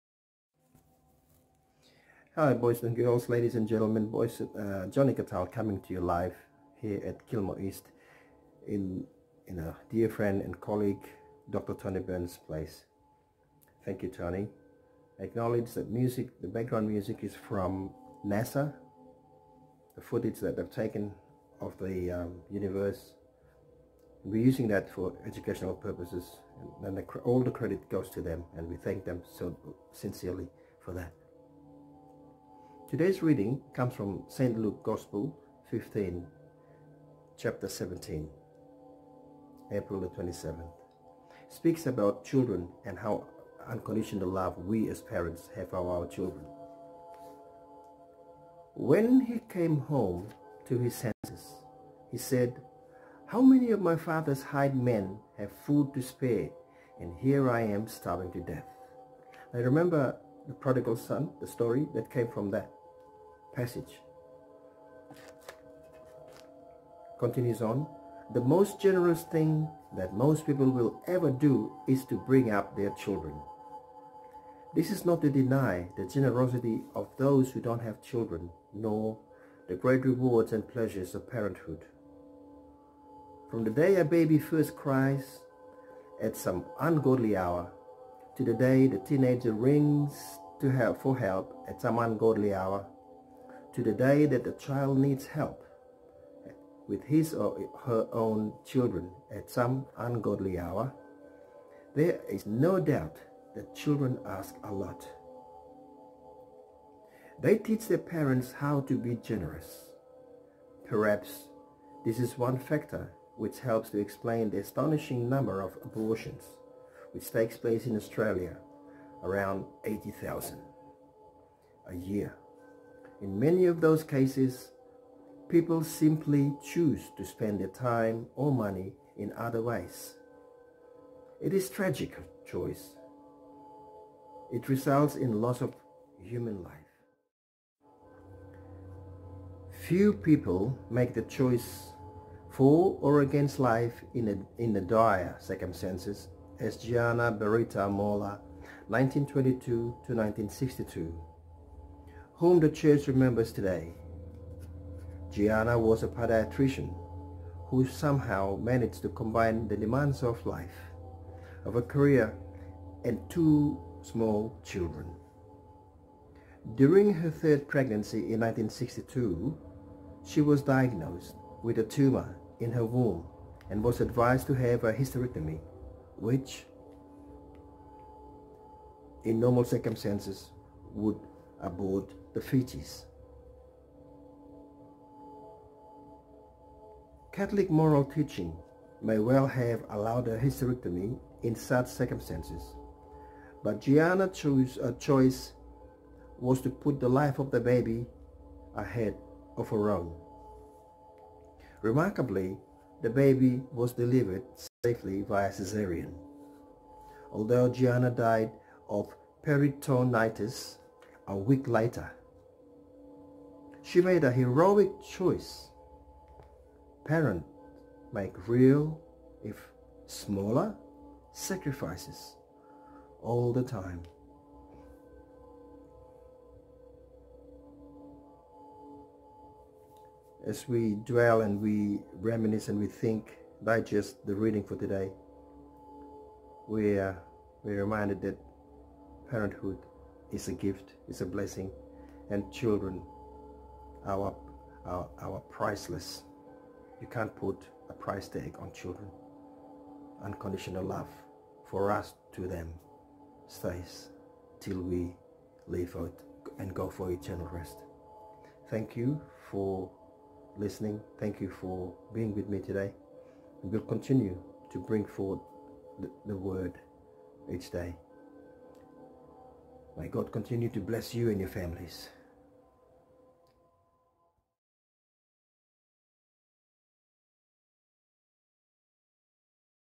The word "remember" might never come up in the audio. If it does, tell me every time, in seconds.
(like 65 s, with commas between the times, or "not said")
59 s, 153 s.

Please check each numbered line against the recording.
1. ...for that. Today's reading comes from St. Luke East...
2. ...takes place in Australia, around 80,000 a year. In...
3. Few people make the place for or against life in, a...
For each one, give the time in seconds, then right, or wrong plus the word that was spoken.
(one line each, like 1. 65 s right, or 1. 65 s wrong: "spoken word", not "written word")
1. 30 s wrong: "Gospel", not "East"
2. 117 s right
3. 139 s wrong: "choice", not "place".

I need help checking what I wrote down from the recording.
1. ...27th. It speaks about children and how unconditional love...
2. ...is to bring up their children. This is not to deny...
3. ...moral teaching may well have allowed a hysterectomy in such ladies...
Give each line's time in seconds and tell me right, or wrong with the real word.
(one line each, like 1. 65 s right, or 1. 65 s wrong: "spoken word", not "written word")
1. 40 s right
2. 71 s right
3. 187 s wrong: "circumstances", not "ladies".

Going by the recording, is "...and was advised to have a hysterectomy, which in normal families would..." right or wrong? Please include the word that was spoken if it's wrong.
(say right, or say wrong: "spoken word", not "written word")
wrong: "circumstances", not "families".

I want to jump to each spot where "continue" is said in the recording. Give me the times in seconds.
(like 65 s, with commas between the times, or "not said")
67 s, 263 s, 270 s.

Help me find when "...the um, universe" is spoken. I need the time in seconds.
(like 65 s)
21 s.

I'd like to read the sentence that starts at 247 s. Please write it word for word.
You can't put a price tag on children.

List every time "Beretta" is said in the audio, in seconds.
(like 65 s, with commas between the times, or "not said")
147 s.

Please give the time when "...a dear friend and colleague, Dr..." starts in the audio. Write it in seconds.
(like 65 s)
9 s.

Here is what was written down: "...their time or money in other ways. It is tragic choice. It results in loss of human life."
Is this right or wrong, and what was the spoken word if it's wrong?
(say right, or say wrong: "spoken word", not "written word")
right.